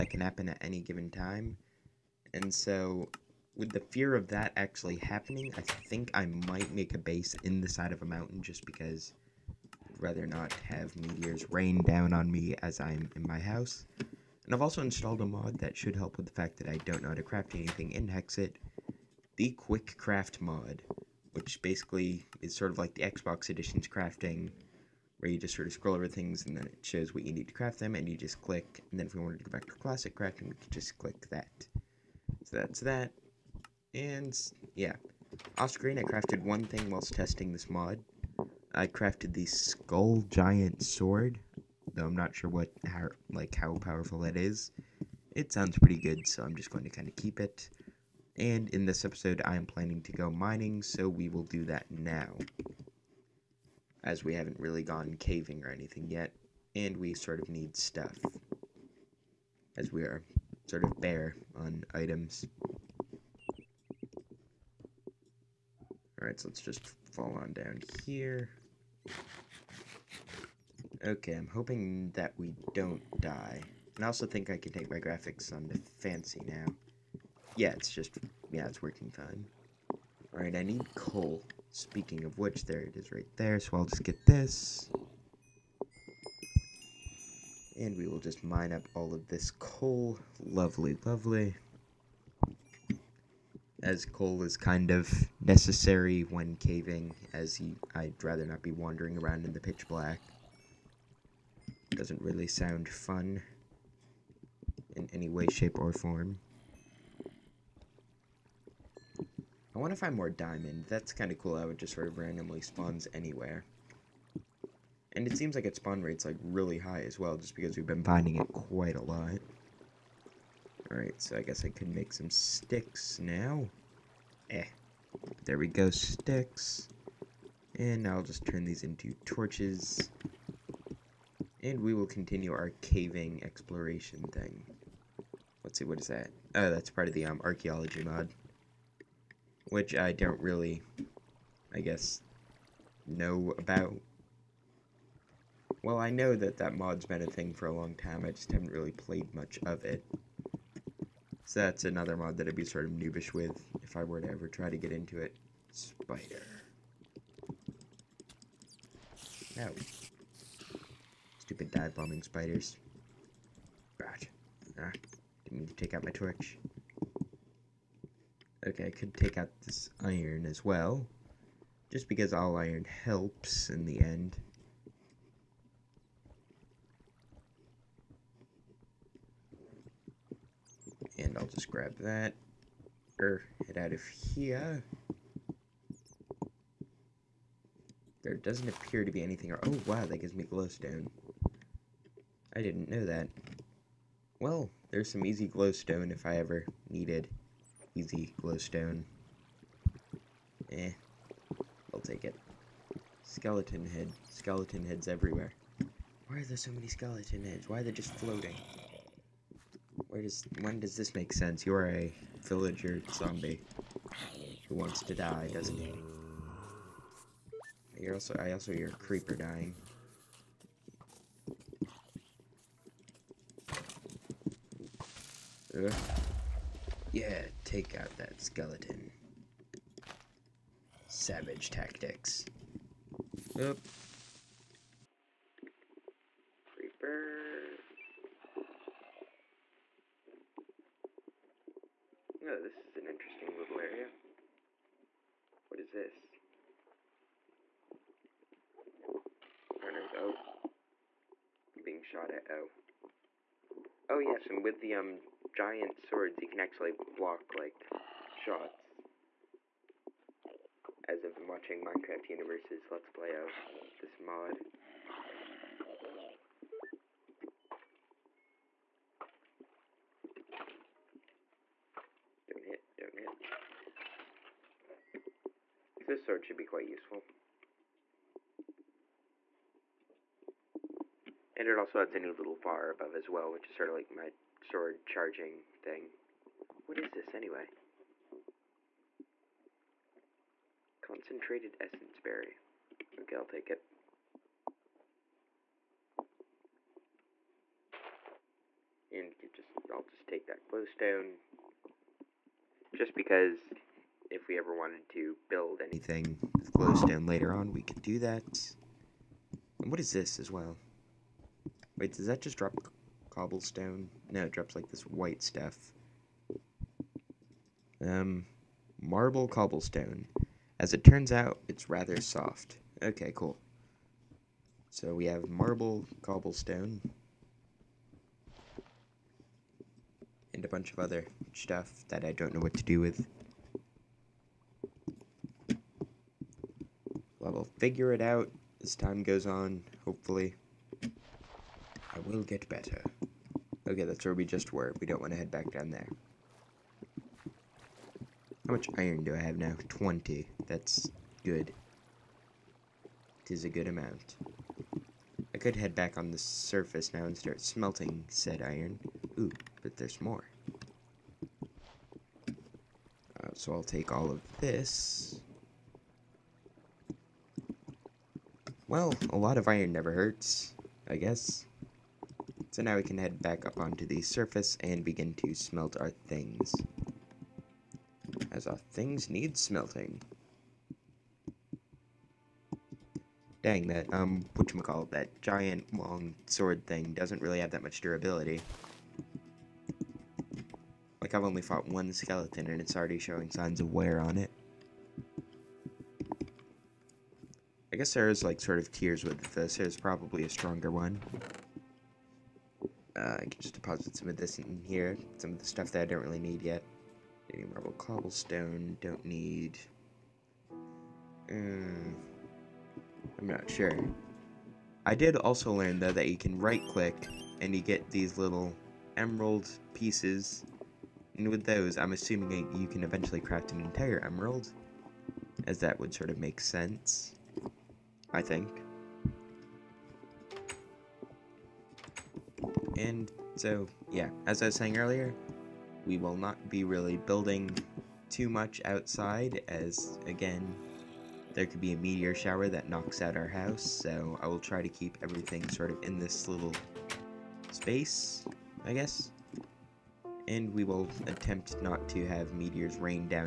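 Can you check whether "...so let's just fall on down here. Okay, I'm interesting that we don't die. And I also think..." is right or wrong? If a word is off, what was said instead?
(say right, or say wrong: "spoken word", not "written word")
wrong: "hoping", not "interesting".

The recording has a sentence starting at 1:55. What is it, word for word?
And it seems like its spawn rate's like really high as well, just because we've been finding it quite a lot.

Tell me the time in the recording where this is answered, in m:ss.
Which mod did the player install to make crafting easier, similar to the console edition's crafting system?
0:19.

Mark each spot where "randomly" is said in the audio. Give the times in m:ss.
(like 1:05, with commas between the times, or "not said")
1:52.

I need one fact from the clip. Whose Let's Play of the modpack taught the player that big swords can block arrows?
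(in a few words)
Minecraft Universe.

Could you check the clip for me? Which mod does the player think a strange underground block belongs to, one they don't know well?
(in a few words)
archaeology mod.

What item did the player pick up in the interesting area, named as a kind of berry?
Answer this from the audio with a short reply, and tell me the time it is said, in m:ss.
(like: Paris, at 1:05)
Concentrated essence berry, at 4:51.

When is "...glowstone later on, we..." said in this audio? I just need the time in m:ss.
5:06.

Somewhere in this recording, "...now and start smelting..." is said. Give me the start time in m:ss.
5:57.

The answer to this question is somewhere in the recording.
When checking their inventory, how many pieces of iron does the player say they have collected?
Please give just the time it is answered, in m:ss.
5:49.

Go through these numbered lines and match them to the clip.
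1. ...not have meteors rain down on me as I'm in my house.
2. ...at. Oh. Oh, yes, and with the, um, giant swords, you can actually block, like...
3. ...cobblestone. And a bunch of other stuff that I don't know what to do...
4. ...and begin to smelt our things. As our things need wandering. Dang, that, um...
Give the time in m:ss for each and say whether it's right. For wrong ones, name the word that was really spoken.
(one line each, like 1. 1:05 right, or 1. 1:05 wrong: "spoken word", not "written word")
1. 0:10 right
2. 4:12 right
3. 5:26 right
4. 6:14 wrong: "smelting", not "wandering".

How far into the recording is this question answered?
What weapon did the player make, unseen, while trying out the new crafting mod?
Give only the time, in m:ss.
0:39.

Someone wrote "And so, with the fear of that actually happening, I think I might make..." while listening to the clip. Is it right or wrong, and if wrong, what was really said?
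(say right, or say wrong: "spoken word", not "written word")
right.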